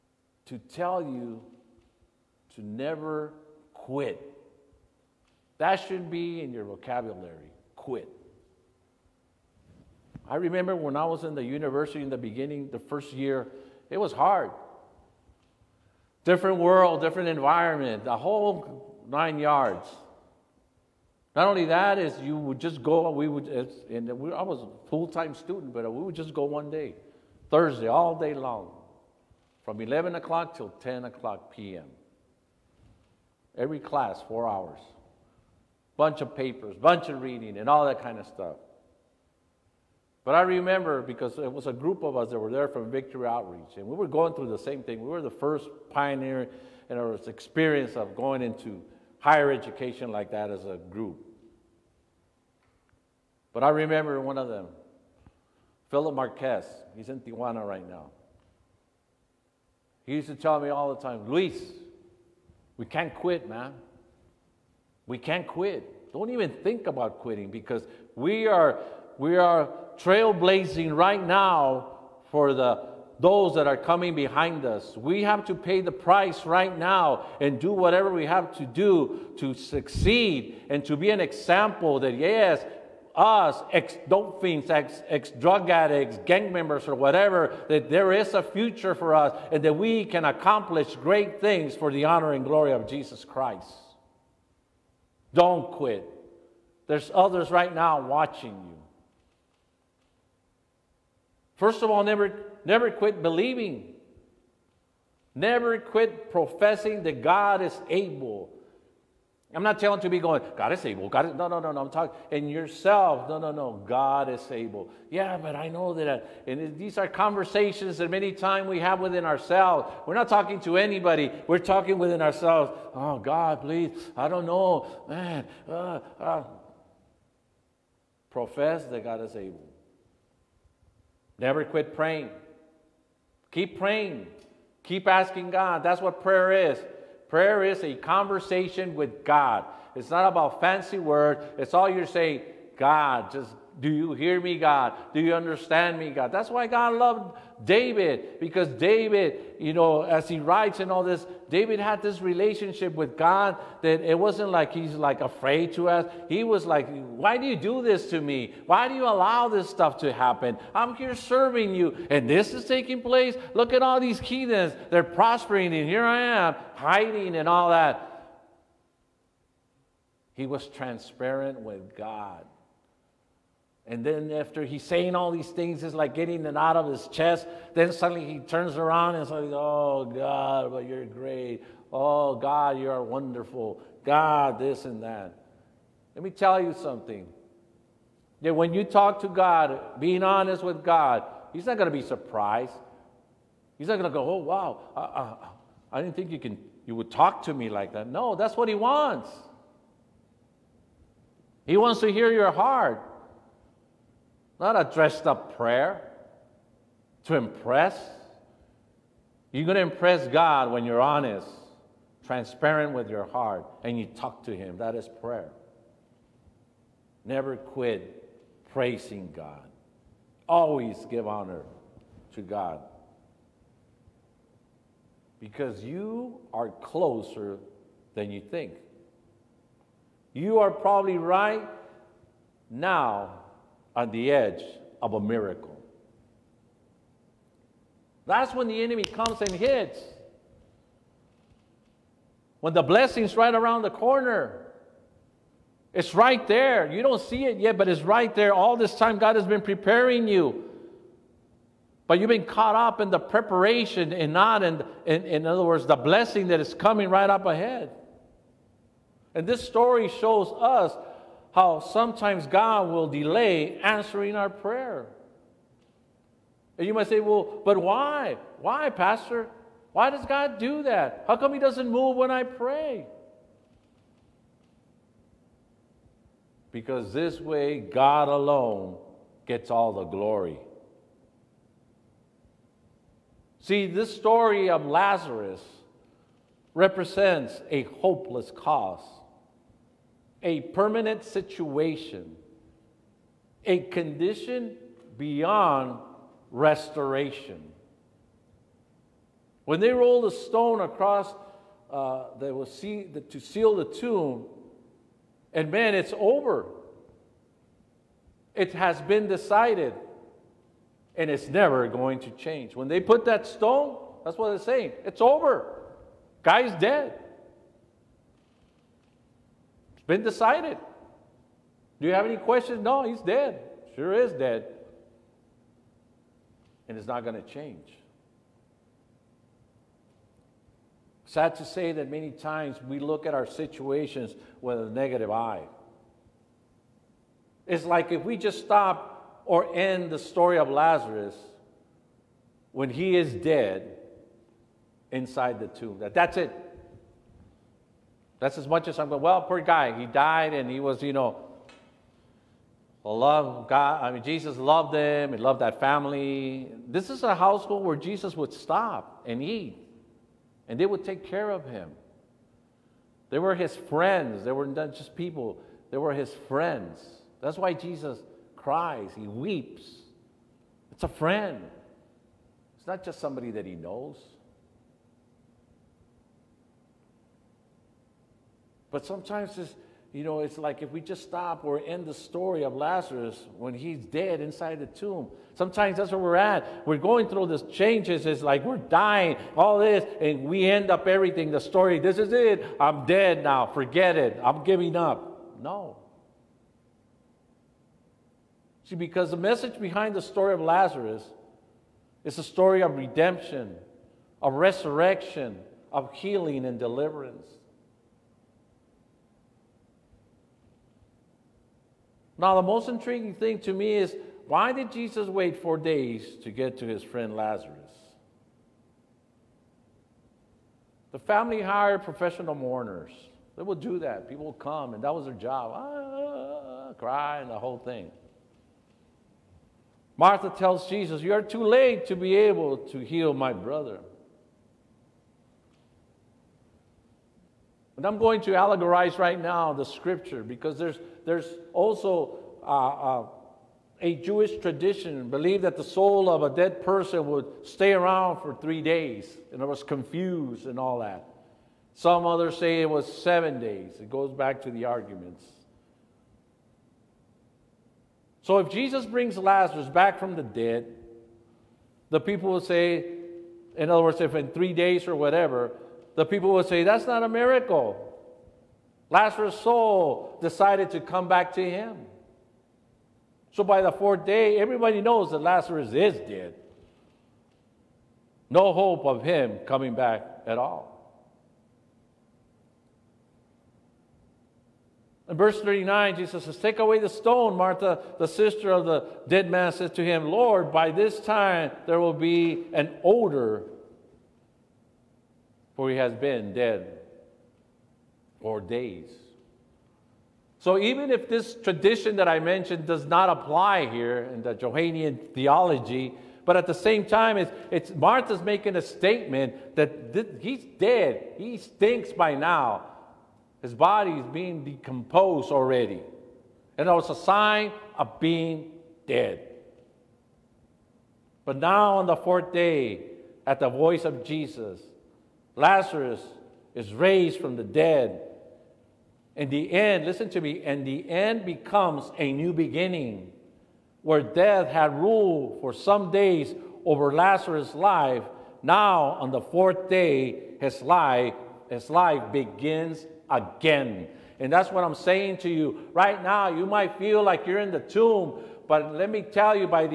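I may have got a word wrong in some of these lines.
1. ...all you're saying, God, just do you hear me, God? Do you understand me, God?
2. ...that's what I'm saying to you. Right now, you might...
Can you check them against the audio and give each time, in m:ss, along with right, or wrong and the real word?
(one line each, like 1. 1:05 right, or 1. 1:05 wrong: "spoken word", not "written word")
1. 2:21 right
2. 9:04 right.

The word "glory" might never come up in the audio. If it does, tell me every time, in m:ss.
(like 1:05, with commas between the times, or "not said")
1:32, 4:40.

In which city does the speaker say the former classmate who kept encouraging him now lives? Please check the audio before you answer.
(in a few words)
Tijuana.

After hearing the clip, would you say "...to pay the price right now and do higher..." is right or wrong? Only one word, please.
wrong.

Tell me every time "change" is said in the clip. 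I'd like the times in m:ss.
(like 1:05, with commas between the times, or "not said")
5:12, 5:27, 6:27.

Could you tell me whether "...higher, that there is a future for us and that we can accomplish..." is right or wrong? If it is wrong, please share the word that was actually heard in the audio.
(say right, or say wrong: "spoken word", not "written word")
wrong: "whatever", not "higher".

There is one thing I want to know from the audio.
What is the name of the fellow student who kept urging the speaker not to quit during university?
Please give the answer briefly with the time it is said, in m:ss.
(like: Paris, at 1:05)
Philip Marquez, at 0:55.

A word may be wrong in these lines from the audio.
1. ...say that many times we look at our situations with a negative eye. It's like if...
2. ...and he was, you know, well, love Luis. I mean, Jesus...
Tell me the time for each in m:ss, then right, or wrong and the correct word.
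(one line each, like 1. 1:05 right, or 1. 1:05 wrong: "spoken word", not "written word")
1. 5:31 right
2. 5:50 wrong: "God", not "Luis".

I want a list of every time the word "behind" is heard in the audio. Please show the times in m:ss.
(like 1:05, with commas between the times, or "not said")
1:14, 6:39.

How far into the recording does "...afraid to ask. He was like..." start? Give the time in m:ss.
2:35.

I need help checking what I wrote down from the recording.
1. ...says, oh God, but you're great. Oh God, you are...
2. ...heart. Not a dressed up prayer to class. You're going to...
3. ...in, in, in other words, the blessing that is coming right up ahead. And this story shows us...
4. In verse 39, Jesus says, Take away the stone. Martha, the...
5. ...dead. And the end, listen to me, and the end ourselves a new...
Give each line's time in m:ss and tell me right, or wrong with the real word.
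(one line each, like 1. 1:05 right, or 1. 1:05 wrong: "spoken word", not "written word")
1. 2:59 right
2. 3:22 wrong: "impress", not "class"
3. 4:14 right
4. 8:05 right
5. 8:47 wrong: "becomes", not "ourselves".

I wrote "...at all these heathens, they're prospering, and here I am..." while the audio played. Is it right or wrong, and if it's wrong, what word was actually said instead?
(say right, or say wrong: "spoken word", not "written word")
right.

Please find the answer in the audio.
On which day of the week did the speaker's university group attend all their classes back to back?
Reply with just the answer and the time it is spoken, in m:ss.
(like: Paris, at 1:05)
Thursday, at 0:27.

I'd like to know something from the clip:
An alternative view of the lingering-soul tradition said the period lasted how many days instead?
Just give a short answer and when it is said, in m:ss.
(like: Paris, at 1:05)
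7, at 7:33.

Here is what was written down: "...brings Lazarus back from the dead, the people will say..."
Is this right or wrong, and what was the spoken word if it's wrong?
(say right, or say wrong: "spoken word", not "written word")
right.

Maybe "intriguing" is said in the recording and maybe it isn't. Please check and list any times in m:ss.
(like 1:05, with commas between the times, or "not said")
6:52.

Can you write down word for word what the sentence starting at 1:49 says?
I'm not telling to be going, God is able.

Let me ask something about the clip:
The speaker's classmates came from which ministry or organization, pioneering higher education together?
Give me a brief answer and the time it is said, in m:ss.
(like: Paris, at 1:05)
Victory Outreach, at 0:42.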